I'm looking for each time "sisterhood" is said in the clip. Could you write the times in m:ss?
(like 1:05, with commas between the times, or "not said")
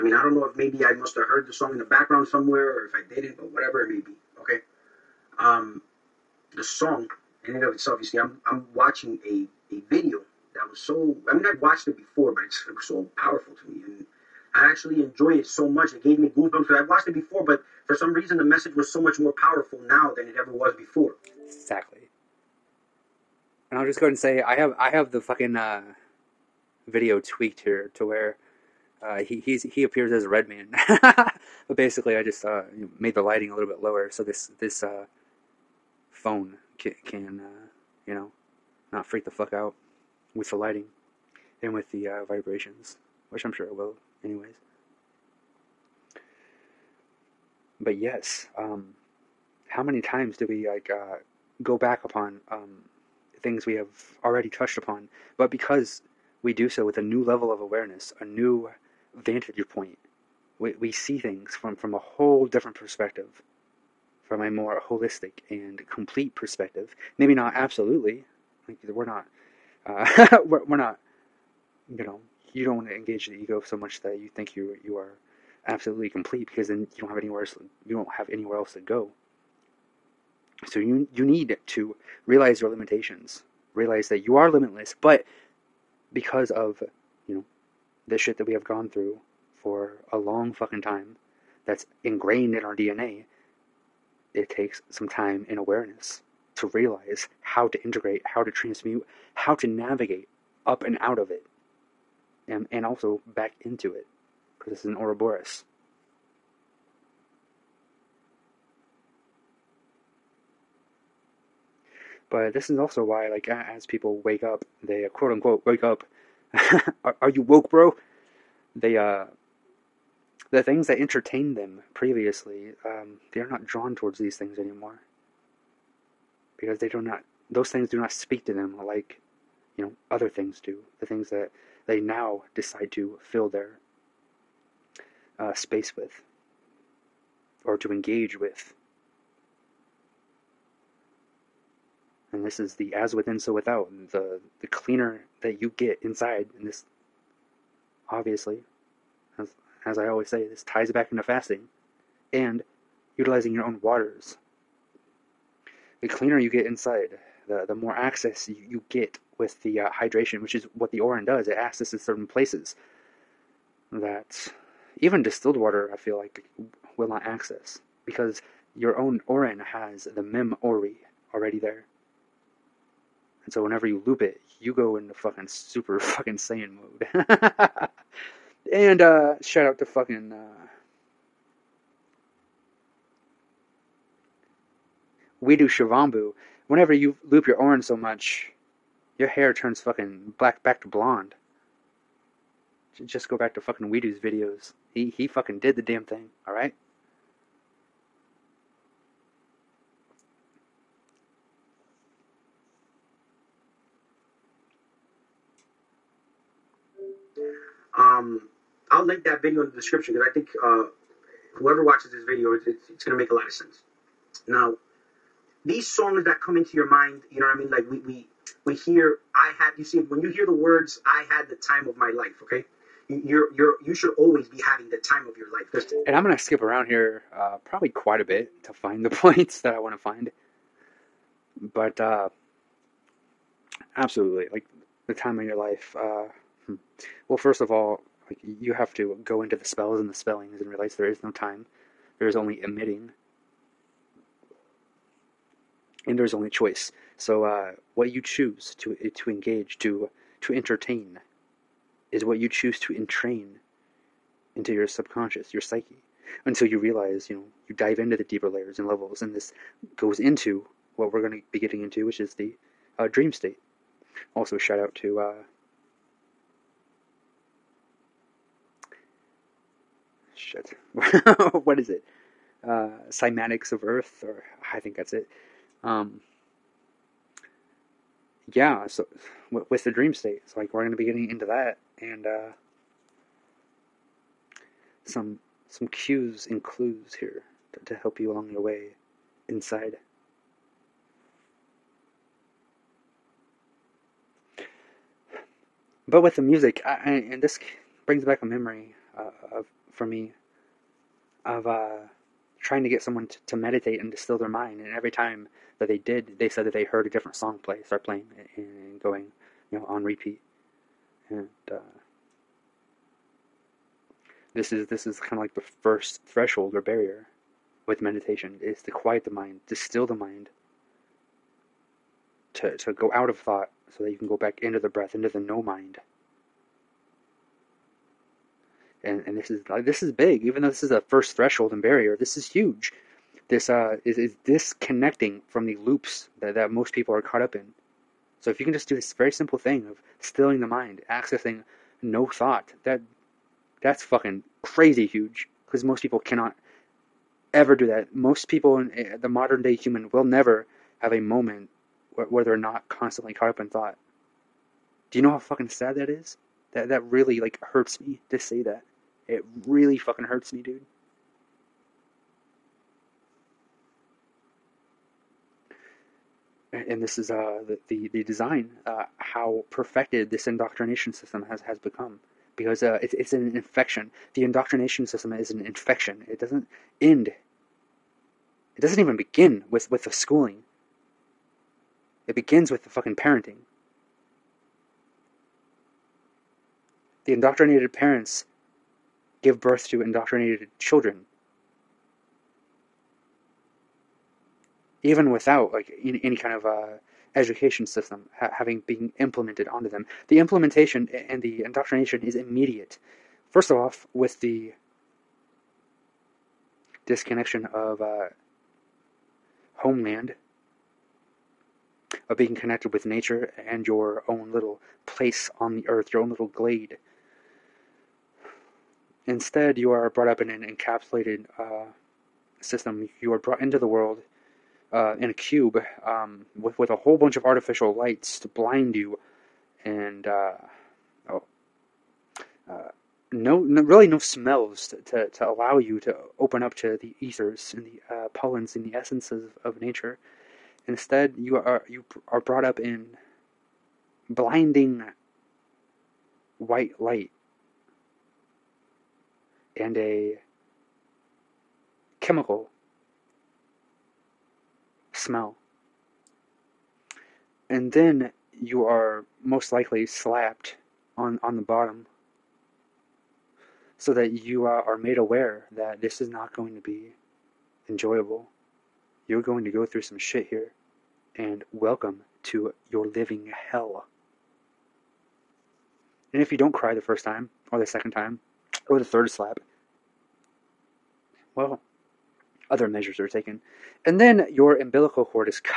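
not said.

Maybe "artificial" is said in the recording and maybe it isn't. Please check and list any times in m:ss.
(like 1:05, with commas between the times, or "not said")
7:07.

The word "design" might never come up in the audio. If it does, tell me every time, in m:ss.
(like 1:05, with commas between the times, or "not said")
6:08.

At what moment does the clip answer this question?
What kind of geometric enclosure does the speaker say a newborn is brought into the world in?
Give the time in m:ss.
7:05.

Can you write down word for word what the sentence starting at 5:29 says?
And, and this is this is big, even though this is the first threshold and barrier.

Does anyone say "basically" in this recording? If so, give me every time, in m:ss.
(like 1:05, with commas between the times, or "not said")
0:31.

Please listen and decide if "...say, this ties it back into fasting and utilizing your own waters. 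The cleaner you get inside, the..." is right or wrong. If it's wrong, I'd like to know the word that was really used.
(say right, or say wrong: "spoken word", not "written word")
right.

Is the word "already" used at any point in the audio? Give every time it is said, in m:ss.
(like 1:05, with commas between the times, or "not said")
0:54, 2:51.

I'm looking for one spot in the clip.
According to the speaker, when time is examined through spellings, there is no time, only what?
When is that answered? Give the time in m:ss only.
4:02.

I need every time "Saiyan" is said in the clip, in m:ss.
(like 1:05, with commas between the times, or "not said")
2:56.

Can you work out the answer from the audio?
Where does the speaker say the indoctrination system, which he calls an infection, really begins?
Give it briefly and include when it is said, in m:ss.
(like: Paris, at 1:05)
parenting, at 6:23.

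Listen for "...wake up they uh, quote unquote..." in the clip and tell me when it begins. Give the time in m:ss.
1:54.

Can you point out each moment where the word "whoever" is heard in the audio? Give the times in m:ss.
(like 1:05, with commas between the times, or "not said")
3:31.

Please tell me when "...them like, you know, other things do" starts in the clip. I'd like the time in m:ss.
2:08.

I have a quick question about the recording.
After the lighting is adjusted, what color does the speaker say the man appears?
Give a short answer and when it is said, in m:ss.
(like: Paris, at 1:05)
red, at 0:30.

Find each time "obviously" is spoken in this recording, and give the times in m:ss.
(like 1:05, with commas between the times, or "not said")
2:28.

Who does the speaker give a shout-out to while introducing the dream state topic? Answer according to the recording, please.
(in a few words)
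Psymatics of Earth.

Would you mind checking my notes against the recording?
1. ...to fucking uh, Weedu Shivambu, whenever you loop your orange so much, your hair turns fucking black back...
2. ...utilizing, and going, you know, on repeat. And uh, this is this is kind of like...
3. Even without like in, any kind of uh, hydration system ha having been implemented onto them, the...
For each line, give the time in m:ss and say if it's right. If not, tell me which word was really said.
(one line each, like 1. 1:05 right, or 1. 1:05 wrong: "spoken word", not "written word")
1. 2:59 right
2. 5:08 wrong: "playing", not "utilizing"
3. 6:35 wrong: "education", not "hydration".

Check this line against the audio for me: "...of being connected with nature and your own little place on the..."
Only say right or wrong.
right.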